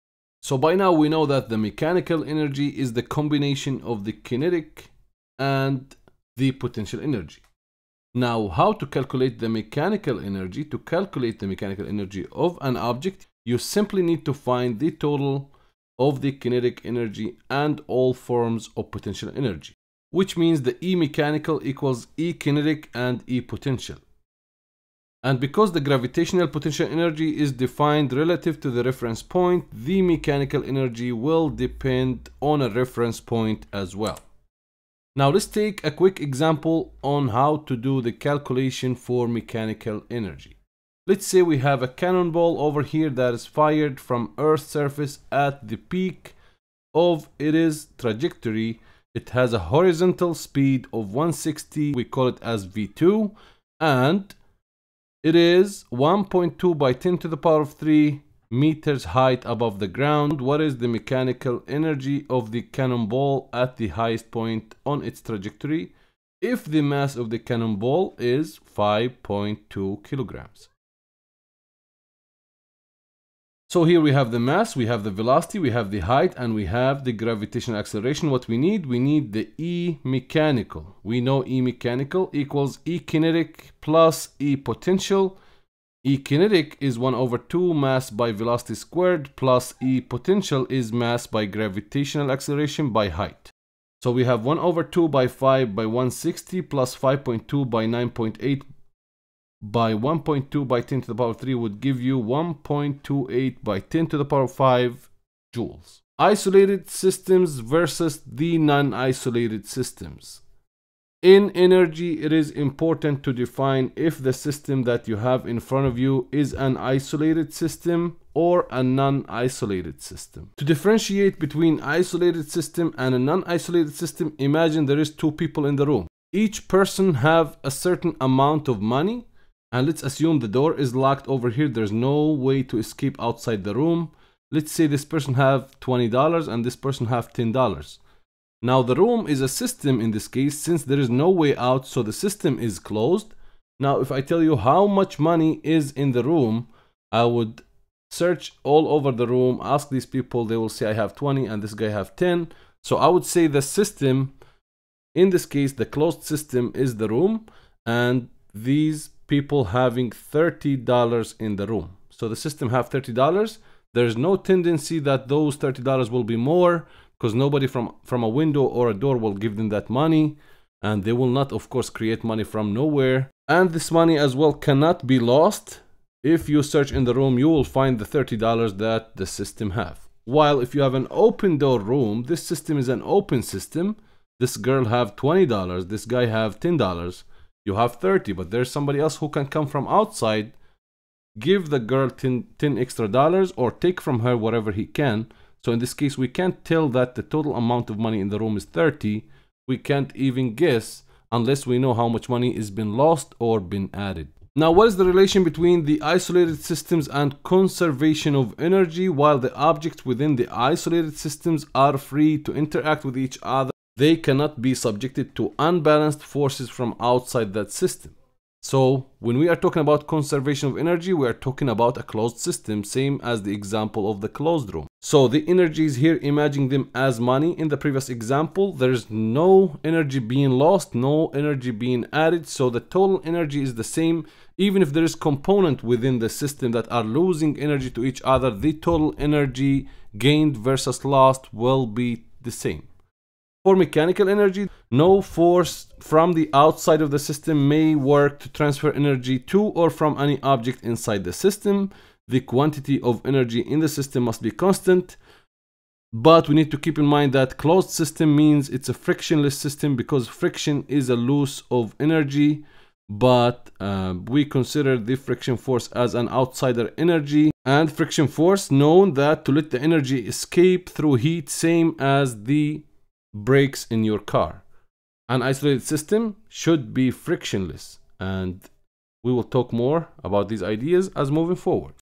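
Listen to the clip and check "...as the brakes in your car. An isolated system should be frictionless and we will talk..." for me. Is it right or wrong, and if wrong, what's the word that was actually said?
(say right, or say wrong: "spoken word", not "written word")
right.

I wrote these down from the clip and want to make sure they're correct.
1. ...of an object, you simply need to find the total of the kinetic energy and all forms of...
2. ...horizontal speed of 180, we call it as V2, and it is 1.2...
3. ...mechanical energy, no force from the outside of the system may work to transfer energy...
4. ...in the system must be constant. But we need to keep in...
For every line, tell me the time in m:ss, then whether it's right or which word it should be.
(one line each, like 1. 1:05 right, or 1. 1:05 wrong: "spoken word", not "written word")
1. 0:12 right
2. 0:49 wrong: "160", not "180"
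3. 4:03 right
4. 4:13 right.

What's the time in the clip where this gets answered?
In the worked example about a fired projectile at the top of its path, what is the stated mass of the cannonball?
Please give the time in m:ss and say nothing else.
1:08.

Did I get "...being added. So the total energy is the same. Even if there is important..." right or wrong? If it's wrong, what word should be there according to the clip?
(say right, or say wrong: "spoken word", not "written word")
wrong: "component", not "important".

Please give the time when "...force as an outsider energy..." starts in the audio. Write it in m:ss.
4:25.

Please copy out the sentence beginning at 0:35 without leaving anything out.
Now let's take a quick example on how to do the calculation for mechanical energy.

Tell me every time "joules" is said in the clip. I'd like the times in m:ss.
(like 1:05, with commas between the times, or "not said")
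1:45.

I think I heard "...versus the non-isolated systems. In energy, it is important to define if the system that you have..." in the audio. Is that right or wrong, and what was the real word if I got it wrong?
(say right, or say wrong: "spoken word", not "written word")
right.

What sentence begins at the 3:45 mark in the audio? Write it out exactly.
So the energies here, imagine them as money.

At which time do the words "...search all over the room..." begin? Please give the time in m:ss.
2:28.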